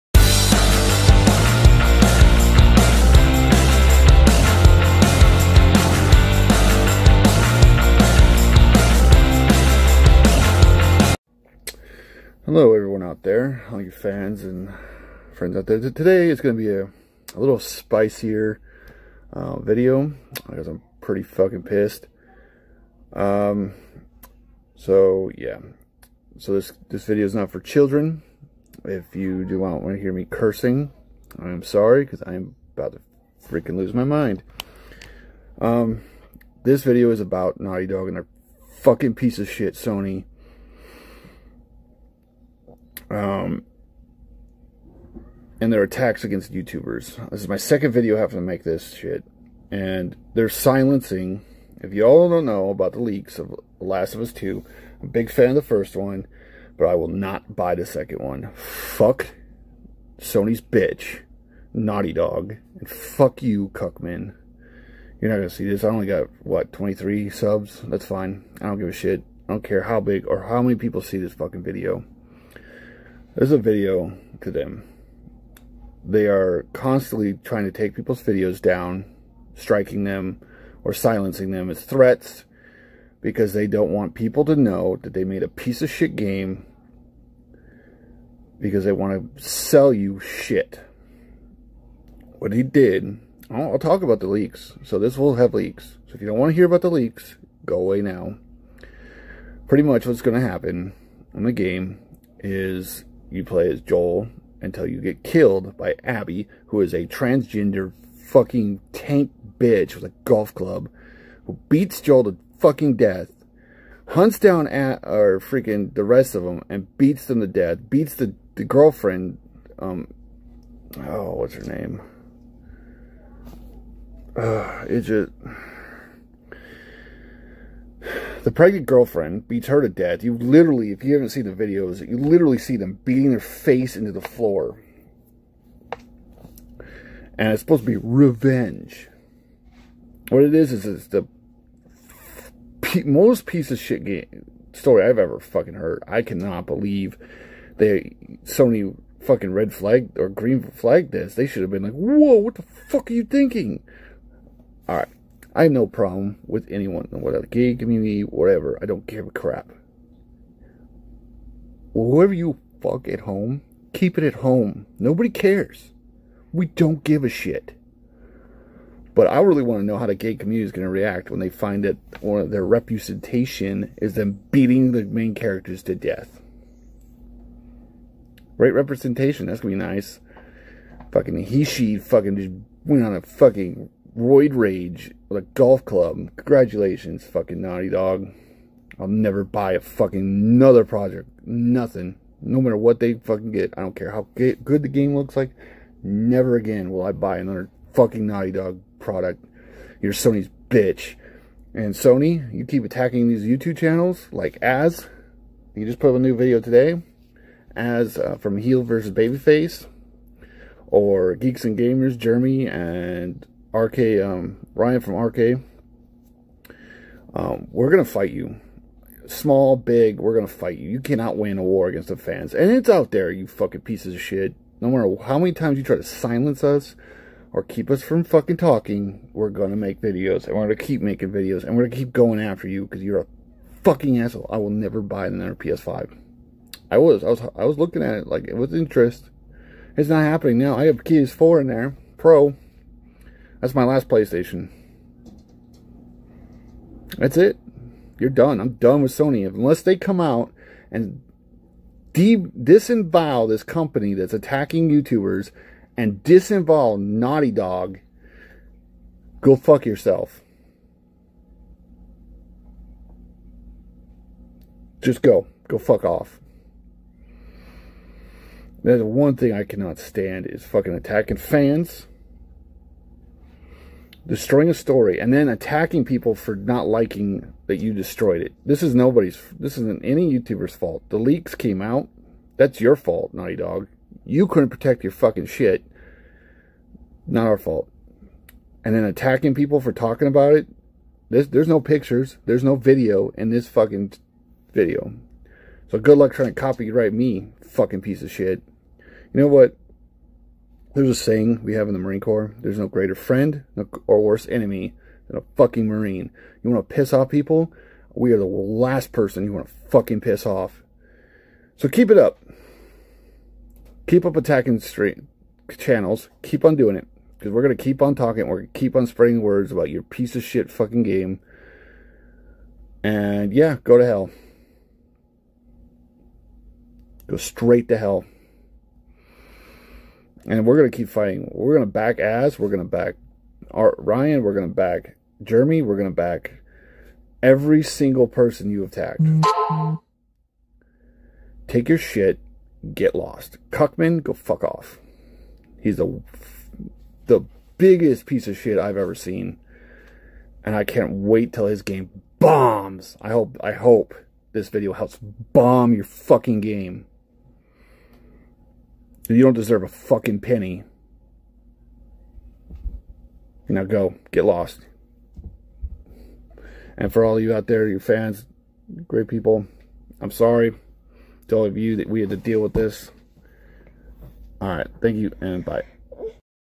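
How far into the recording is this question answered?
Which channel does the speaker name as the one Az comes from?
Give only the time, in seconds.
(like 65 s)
208 s.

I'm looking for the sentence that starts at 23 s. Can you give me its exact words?
Um, so yeah, so this, this video is not for children.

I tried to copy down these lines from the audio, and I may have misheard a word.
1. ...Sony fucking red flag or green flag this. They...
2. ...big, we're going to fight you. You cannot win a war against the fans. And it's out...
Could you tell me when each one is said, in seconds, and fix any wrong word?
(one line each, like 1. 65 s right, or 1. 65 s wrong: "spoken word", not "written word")
1. 148 s right
2. 219 s right.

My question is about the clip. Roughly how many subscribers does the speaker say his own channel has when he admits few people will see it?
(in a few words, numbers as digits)
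23.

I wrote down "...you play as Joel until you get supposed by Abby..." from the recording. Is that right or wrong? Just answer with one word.
wrong.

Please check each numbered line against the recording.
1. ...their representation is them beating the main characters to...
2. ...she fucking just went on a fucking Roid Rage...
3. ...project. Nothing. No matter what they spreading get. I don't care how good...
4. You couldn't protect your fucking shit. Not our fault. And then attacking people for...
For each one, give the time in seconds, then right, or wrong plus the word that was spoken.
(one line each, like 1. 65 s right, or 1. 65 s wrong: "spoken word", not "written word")
1. 172 s right
2. 181 s right
3. 190 s wrong: "fucking", not "spreading"
4. 284 s right.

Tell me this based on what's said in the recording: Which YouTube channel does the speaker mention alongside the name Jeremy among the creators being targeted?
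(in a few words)
Geeks and Gamers.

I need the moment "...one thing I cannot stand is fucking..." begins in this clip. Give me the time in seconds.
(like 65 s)
269 s.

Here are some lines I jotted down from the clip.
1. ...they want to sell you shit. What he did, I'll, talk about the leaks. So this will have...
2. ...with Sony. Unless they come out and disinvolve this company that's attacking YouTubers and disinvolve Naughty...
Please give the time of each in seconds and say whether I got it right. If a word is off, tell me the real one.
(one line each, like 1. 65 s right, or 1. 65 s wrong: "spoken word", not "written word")
1. 88 s right
2. 249 s right.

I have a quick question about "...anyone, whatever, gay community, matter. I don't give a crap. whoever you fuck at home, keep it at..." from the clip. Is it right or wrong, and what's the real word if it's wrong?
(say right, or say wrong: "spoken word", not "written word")
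wrong: "whatever", not "matter".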